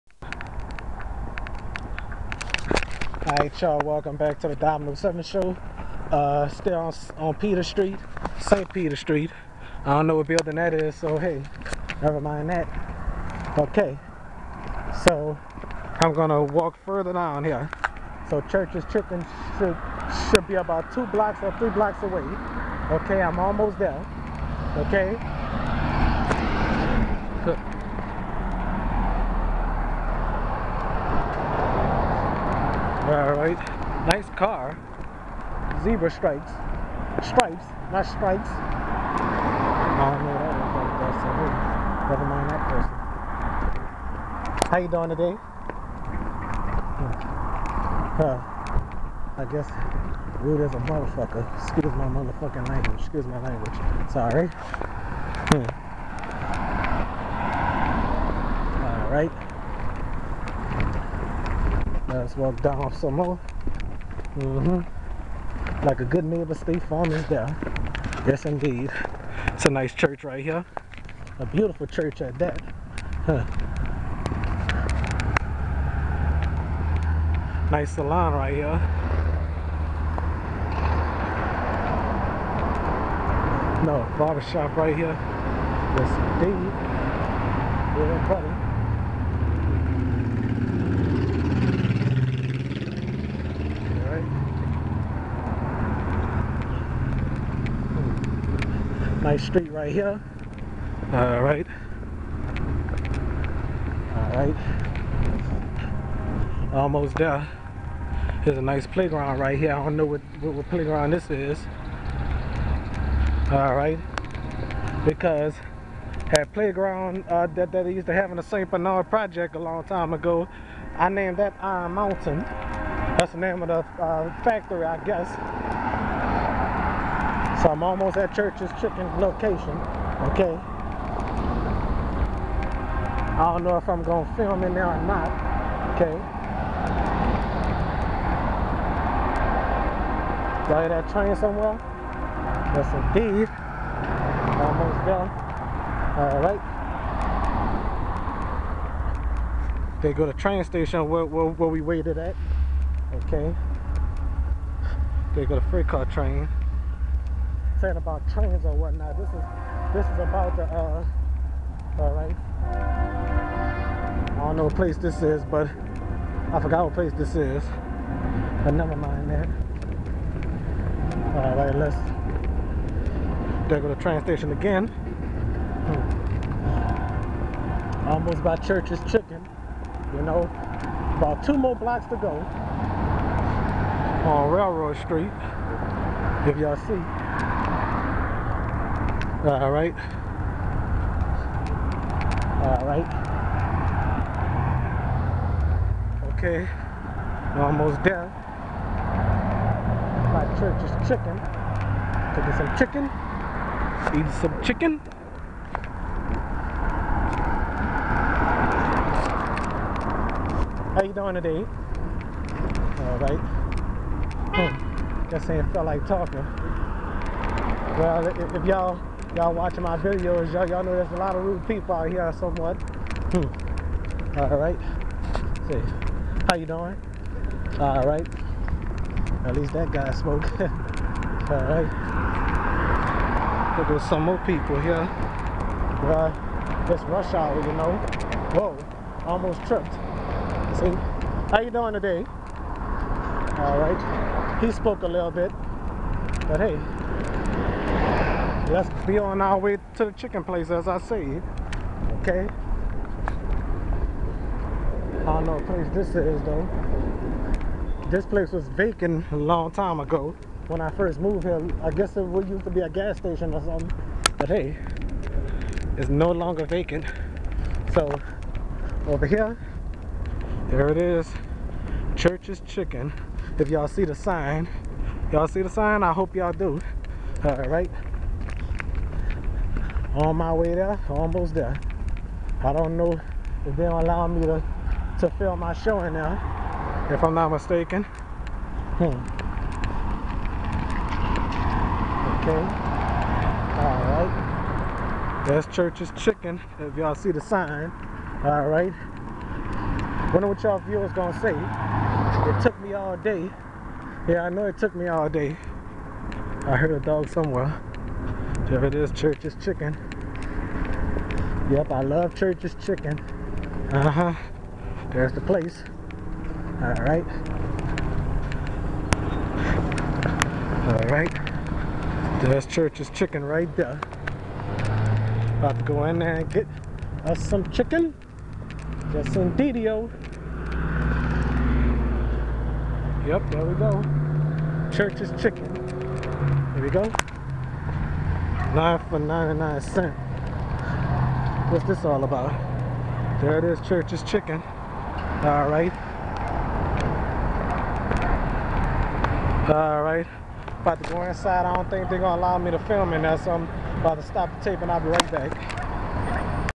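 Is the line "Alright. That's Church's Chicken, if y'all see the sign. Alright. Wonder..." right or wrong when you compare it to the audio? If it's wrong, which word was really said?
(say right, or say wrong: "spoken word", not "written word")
right.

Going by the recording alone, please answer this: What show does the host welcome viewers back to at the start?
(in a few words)
Domino 7 show.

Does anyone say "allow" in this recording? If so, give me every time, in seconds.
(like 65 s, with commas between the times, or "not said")
283 s, 352 s.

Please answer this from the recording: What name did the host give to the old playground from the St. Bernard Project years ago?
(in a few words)
Iron Mountain.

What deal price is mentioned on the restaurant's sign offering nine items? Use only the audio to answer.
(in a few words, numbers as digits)
99 cents.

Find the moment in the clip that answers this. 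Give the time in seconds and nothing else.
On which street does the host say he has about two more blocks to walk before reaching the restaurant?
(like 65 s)
184 s.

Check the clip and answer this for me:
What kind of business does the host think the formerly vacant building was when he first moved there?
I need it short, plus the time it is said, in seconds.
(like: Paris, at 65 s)
A gas station, at 262 s.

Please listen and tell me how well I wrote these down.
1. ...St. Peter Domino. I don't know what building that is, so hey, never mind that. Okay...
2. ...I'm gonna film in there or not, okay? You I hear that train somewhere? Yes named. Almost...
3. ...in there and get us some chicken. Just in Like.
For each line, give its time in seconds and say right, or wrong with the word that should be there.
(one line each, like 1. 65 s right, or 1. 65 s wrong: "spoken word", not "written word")
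1. 8 s wrong: "Street", not "Domino"
2. 133 s wrong: "indeed", not "named"
3. 326 s wrong: "DDO", not "Like".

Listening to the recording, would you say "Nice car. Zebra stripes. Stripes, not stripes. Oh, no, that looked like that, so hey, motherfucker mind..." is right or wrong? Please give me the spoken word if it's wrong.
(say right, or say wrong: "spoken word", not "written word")
wrong: "never", not "motherfucker".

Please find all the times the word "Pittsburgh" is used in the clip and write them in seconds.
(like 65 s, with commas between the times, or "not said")
not said.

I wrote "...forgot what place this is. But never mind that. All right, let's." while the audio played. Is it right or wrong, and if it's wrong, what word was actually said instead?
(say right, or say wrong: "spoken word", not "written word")
right.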